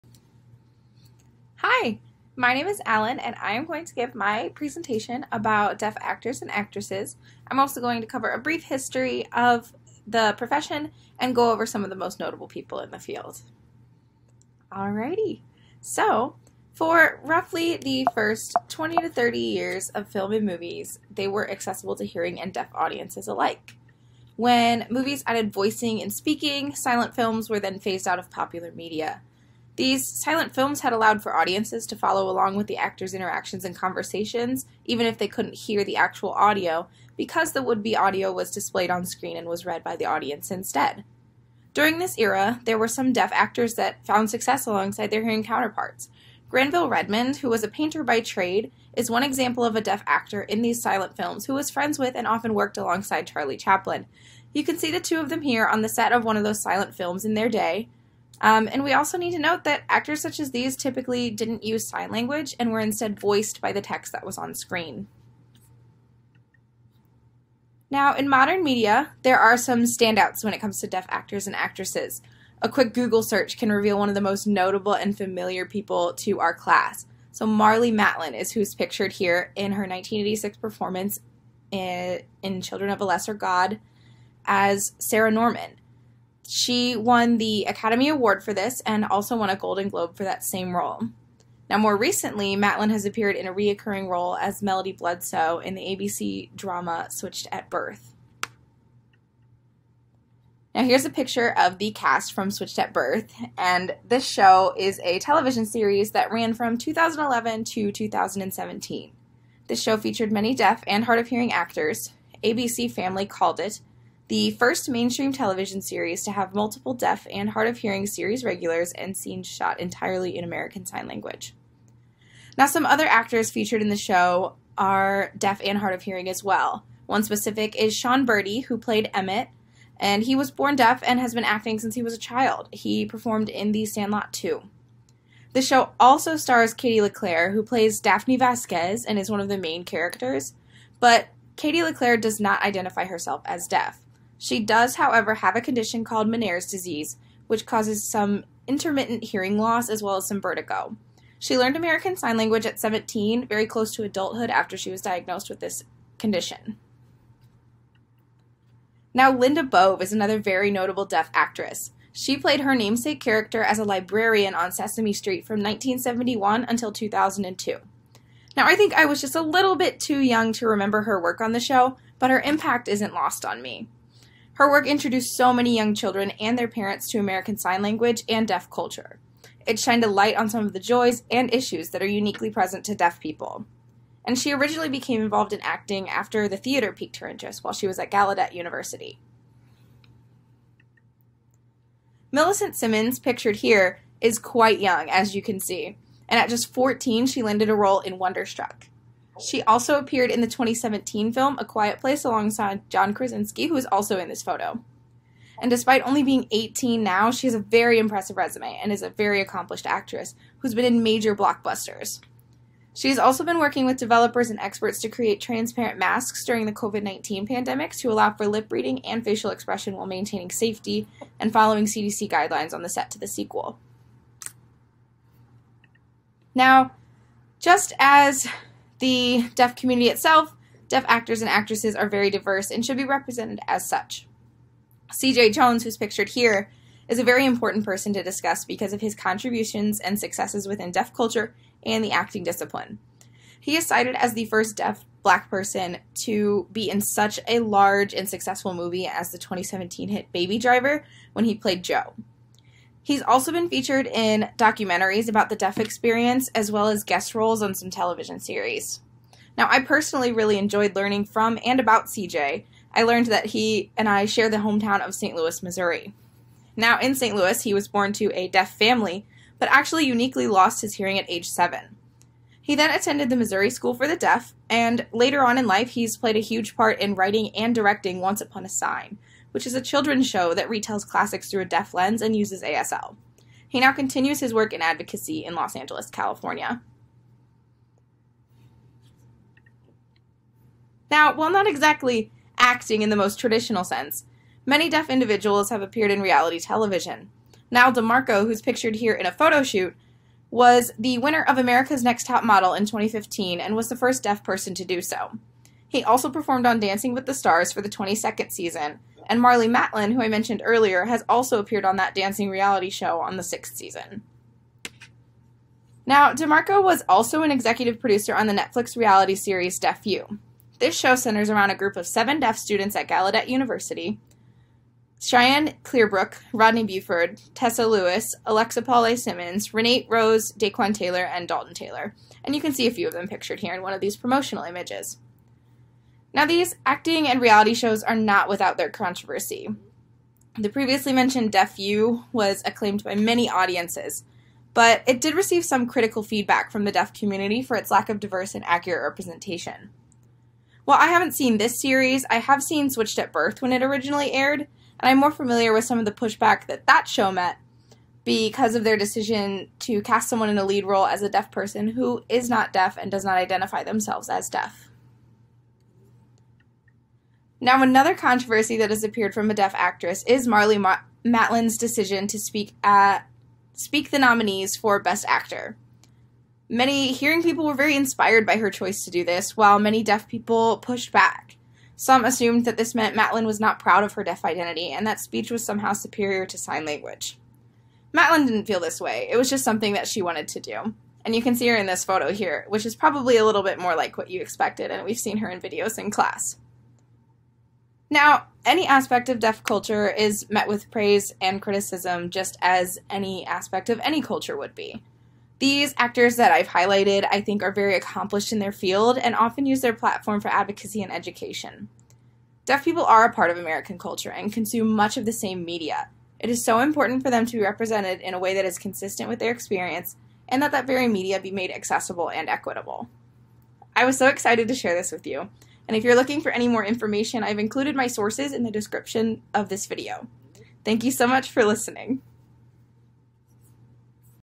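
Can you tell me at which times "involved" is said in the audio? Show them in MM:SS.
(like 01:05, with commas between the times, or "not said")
03:05.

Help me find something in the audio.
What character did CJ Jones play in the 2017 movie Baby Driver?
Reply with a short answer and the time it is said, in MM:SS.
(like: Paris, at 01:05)
Joe, at 04:11.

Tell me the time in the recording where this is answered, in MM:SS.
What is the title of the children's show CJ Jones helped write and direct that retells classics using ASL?
04:38.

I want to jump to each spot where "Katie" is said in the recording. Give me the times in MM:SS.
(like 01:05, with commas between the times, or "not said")
02:16, 02:21.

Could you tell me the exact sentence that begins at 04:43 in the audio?
He now continues his work in advocacy in Los Angeles, California.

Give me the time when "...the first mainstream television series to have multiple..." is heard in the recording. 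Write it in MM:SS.
01:54.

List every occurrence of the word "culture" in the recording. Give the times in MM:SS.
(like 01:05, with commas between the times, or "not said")
02:58, 04:01, 06:39, 06:44, 06:53.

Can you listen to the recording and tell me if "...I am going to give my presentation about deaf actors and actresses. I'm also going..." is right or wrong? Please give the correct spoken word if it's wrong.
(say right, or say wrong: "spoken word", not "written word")
right.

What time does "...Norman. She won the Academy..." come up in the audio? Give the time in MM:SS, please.
01:25.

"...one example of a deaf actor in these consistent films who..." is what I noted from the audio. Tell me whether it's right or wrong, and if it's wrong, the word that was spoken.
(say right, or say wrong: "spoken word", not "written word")
wrong: "silent", not "consistent".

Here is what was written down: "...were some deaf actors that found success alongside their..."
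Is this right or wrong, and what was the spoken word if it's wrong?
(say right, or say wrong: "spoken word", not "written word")
right.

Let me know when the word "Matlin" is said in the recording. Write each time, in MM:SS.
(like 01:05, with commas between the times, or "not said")
01:17, 01:32, 05:09, 06:11, 06:23, 06:28.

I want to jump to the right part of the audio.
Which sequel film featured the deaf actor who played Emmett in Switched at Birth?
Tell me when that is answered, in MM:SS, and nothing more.
02:13.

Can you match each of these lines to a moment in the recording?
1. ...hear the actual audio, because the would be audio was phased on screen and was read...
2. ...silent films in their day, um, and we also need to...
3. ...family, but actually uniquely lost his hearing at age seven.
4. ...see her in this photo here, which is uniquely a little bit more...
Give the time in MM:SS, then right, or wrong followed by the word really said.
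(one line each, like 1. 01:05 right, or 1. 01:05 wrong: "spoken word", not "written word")
1. 00:35 wrong: "displayed", not "phased"
2. 00:56 right
3. 04:28 right
4. 06:31 wrong: "probably", not "uniquely".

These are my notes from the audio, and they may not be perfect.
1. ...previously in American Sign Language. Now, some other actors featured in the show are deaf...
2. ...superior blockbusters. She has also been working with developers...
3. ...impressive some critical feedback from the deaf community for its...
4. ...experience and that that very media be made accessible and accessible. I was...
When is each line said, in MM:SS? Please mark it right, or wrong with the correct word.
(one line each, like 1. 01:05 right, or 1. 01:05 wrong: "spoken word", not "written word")
1. 01:59 wrong: "entirely", not "previously"
2. 03:31 wrong: "major", not "superior"
3. 05:45 wrong: "receive", not "impressive"
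4. 06:59 wrong: "equitable", not "accessible".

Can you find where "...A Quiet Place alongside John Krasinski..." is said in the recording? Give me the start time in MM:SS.
03:21.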